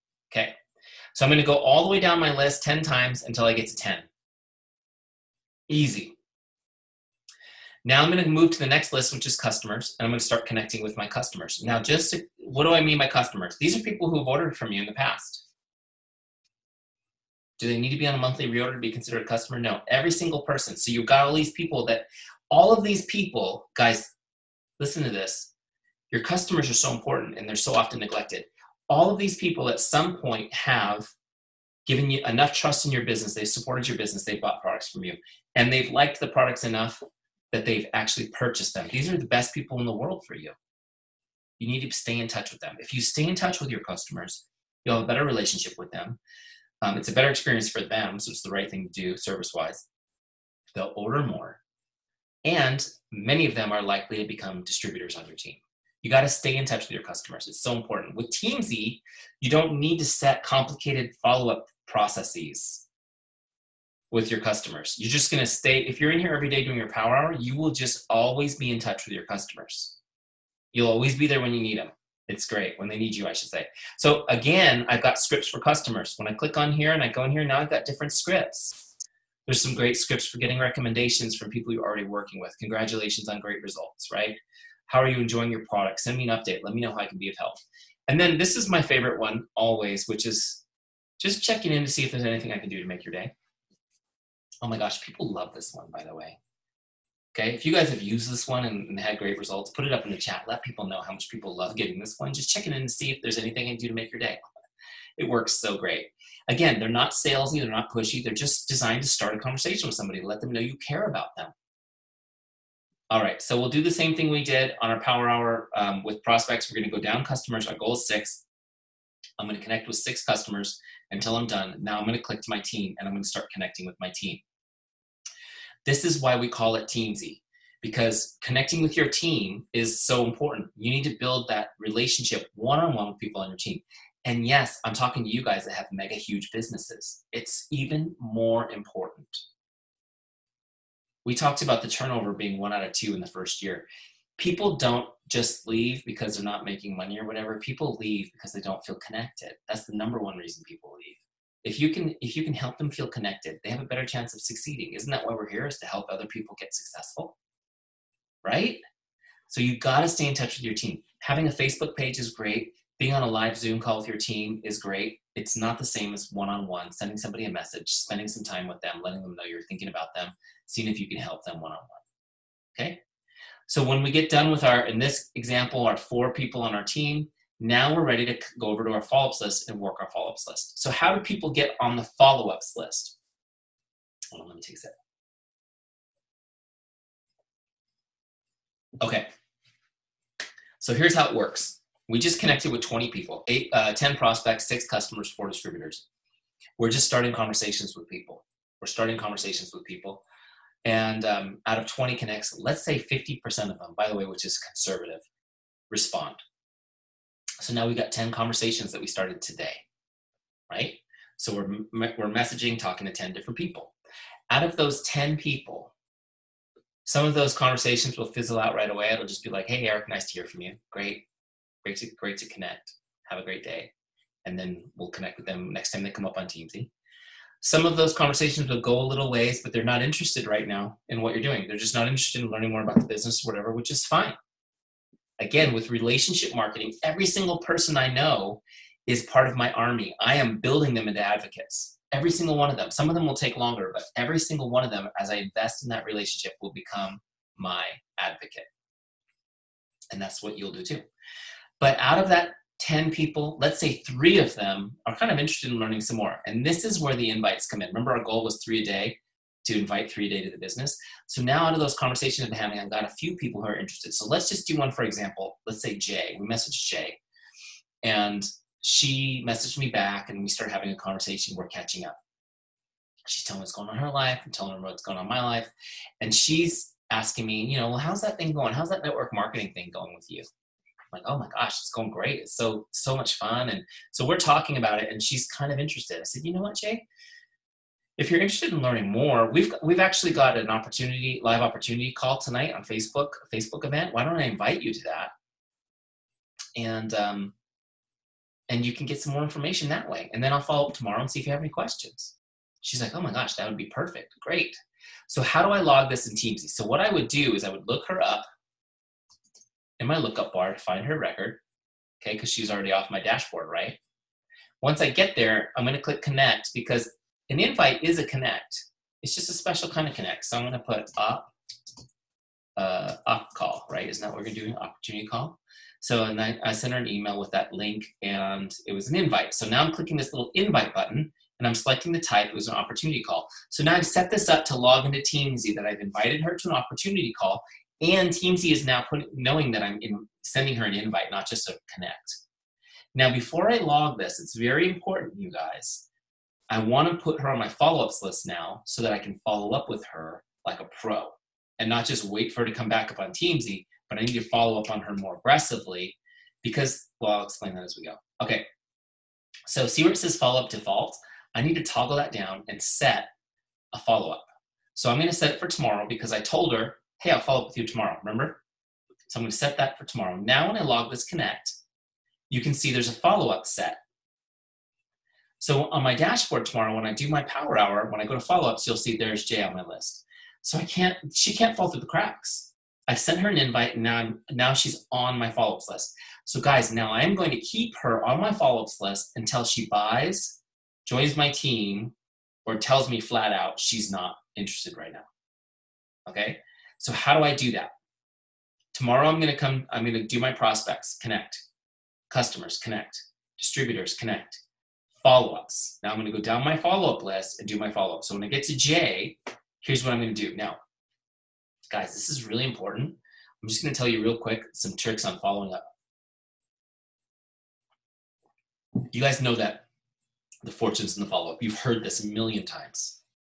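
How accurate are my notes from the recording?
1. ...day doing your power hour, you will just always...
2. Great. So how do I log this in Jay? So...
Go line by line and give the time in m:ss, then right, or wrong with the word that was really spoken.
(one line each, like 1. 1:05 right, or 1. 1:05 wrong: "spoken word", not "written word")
1. 1:06 right
2. 5:04 wrong: "Teamzy", not "Jay".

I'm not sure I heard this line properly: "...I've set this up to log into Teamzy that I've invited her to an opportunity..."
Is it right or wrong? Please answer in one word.
right.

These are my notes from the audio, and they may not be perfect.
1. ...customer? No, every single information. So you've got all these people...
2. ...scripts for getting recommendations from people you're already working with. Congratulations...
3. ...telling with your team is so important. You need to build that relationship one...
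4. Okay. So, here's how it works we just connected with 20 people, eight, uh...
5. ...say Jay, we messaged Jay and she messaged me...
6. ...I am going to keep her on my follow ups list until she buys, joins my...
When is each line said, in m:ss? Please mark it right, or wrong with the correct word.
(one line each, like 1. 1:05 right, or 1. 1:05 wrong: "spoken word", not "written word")
1. 0:19 wrong: "person", not "information"
2. 1:19 right
3. 2:08 wrong: "connecting", not "telling"
4. 3:09 right
5. 4:25 right
6. 6:27 right.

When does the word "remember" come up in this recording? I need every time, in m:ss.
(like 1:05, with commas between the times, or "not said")
4:17, 6:08.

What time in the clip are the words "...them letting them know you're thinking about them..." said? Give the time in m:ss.
2:48.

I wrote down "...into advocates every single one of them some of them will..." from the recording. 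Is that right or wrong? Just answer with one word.
right.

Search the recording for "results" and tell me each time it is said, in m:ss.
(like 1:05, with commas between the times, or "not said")
1:23, 1:39.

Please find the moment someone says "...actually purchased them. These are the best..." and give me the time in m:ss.
0:37.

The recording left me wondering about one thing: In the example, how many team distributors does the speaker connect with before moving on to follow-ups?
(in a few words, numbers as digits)
4.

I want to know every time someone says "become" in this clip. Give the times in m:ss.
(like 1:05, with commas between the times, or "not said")
0:54, 4:06.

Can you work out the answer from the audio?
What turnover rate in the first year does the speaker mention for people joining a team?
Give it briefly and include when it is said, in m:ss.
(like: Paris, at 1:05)
One out of two, at 2:22.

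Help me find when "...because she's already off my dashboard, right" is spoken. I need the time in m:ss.
5:12.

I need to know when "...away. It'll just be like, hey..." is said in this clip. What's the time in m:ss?
3:38.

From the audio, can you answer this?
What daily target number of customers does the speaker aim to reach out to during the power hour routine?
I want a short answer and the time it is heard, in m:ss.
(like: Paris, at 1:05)
6, at 1:57.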